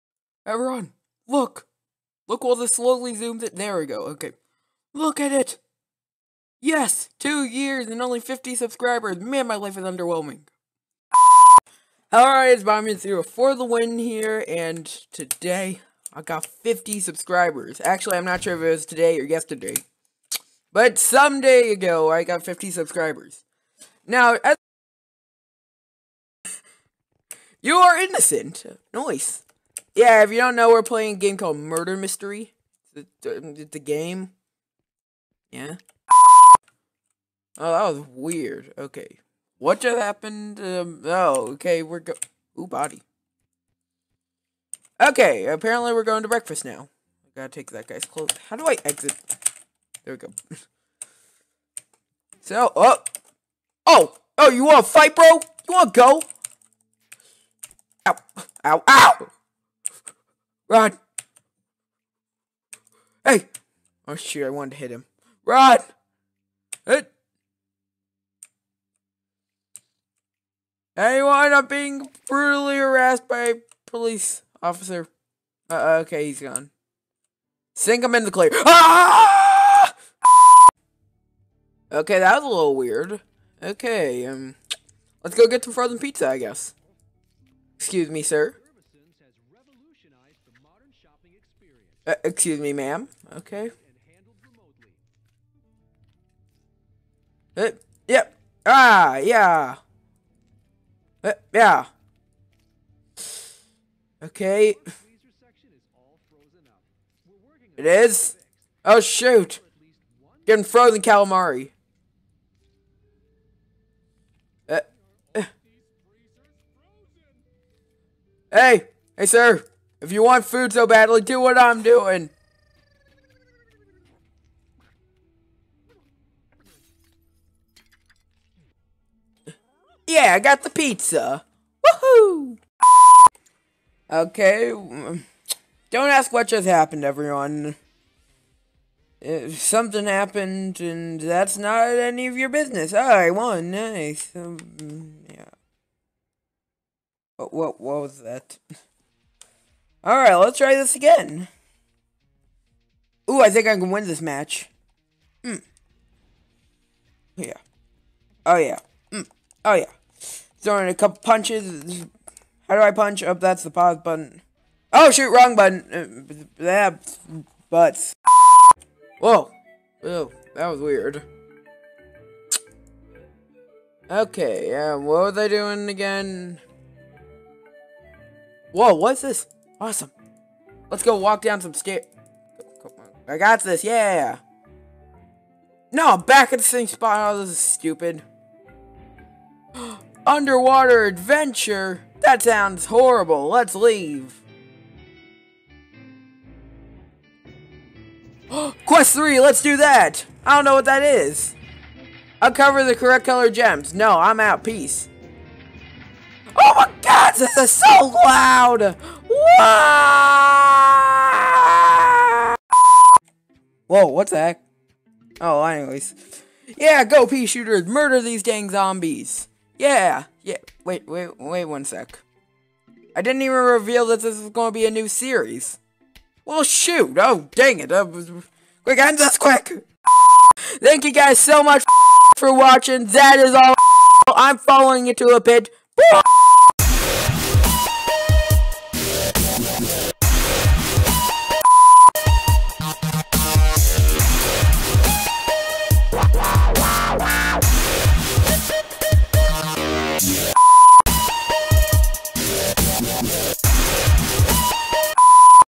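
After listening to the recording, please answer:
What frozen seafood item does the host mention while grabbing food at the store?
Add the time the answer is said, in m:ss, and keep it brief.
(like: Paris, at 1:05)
frozen calamari, at 1:50.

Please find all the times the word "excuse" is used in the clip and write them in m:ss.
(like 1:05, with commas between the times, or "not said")
1:27, 1:32.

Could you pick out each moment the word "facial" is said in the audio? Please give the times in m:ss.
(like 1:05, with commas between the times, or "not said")
not said.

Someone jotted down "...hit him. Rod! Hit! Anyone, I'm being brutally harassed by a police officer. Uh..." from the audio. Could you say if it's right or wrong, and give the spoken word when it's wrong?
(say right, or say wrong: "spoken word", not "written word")
right.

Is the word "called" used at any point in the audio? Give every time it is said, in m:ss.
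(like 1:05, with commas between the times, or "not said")
0:31.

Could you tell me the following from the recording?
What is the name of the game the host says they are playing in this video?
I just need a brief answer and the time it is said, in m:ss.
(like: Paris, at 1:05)
Murder Mystery, at 0:31.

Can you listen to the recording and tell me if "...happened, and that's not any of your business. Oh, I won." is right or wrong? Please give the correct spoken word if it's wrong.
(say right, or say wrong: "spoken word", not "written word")
right.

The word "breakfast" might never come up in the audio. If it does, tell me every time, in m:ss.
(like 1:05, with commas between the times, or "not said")
0:46.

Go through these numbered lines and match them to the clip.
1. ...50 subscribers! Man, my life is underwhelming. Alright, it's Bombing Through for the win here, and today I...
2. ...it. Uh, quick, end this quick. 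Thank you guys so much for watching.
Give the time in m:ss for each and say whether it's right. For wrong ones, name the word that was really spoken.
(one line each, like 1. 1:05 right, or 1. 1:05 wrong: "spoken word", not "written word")
1. 0:08 right
2. 3:47 right.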